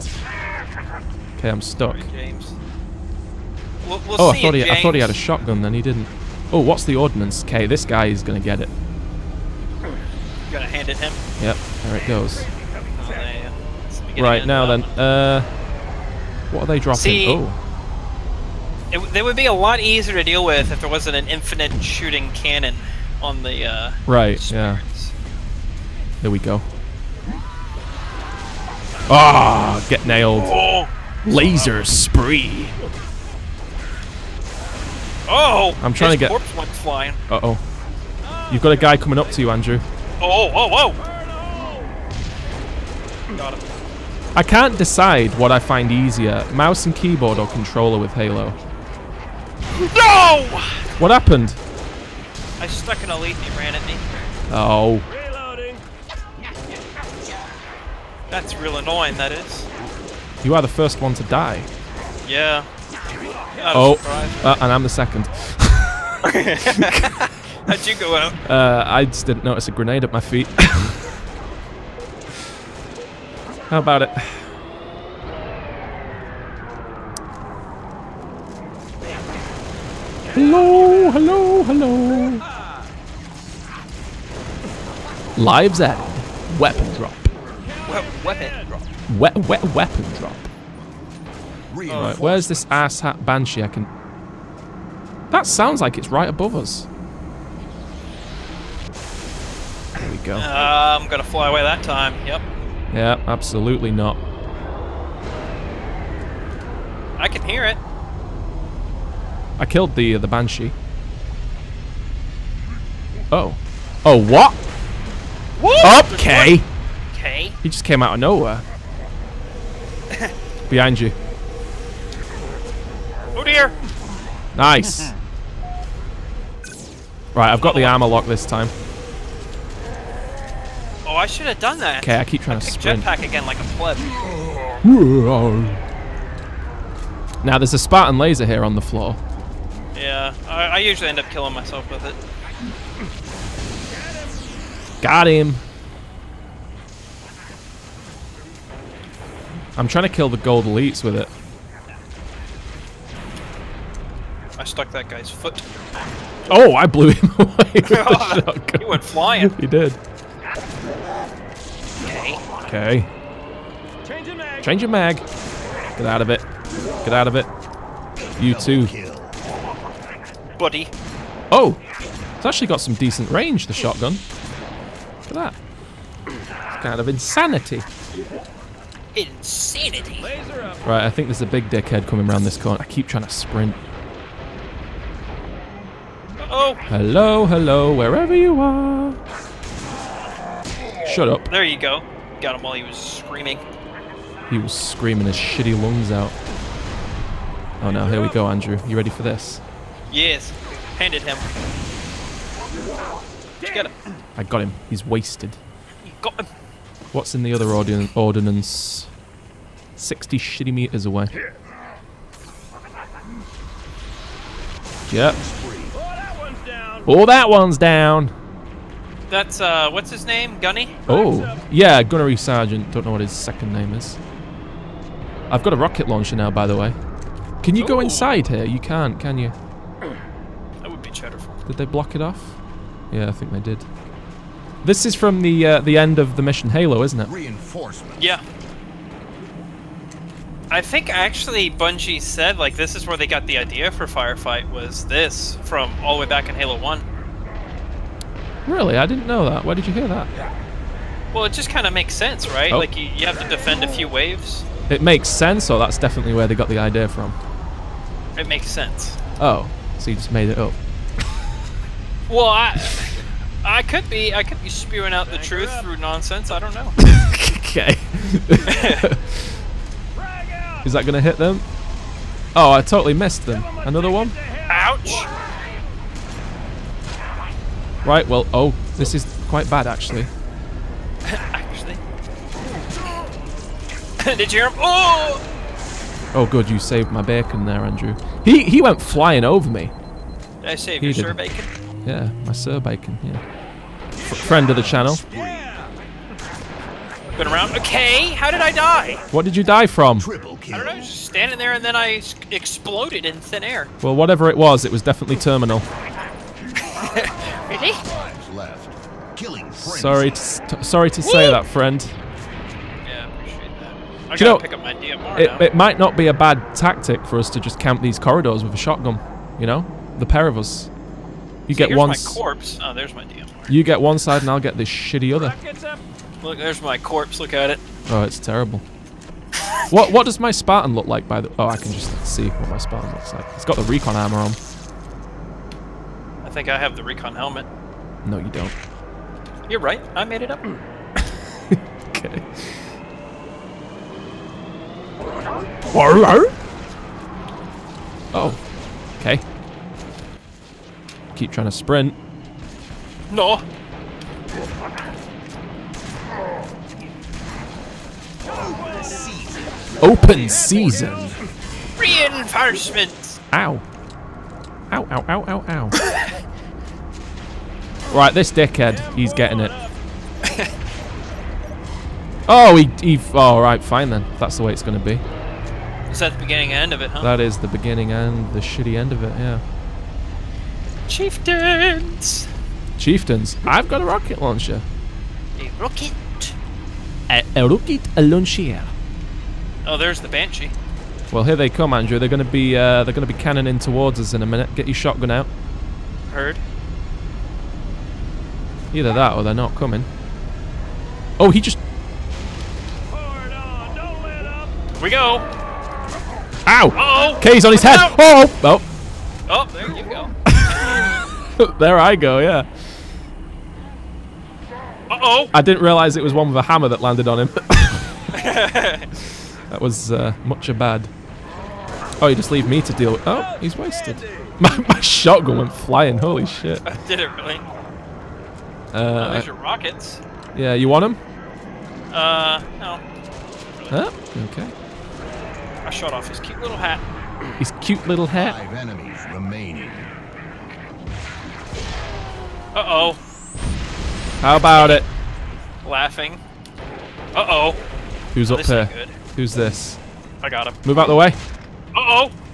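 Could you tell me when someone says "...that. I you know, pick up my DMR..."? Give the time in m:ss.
5:13.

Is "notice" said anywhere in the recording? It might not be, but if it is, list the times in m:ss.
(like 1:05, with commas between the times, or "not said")
1:09.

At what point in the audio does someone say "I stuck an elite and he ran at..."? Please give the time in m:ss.
0:52.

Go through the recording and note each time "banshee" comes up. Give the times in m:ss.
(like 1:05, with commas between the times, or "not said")
1:33, 1:50, 6:30.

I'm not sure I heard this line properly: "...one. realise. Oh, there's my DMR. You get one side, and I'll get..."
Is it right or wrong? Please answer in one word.
wrong.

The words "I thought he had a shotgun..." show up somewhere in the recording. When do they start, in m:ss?
0:04.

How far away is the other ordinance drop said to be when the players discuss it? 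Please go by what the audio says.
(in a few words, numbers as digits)
60 meters.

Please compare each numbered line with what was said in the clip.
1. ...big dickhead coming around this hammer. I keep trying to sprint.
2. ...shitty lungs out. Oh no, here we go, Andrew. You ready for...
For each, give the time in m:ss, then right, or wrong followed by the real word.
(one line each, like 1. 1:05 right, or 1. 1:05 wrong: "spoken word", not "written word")
1. 3:01 wrong: "corner", not "hammer"
2. 3:15 right.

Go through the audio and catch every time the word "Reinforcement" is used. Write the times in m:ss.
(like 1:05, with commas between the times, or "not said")
3:57, 6:01.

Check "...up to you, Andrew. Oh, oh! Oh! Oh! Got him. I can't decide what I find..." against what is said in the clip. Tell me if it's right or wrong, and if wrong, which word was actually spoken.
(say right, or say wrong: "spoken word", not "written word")
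right.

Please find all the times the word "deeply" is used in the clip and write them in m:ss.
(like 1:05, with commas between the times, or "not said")
not said.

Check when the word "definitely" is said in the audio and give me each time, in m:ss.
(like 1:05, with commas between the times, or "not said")
4:15, 5:05.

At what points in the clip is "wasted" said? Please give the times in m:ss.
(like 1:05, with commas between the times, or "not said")
3:25, 7:03.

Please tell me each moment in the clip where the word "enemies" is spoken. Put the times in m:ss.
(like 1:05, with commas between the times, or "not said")
7:18.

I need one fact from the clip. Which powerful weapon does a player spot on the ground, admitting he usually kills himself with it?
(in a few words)
Spartan laser.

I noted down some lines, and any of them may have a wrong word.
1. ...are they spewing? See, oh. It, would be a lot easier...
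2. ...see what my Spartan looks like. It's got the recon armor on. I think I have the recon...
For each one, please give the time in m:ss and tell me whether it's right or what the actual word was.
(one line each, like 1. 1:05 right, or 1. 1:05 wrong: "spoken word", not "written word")
1. 0:16 wrong: "dropping", not "spewing"
2. 5:32 right.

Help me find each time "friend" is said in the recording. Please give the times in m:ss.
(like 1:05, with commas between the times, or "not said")
4:54, 5:11.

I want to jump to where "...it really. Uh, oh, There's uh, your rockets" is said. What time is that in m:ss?
7:07.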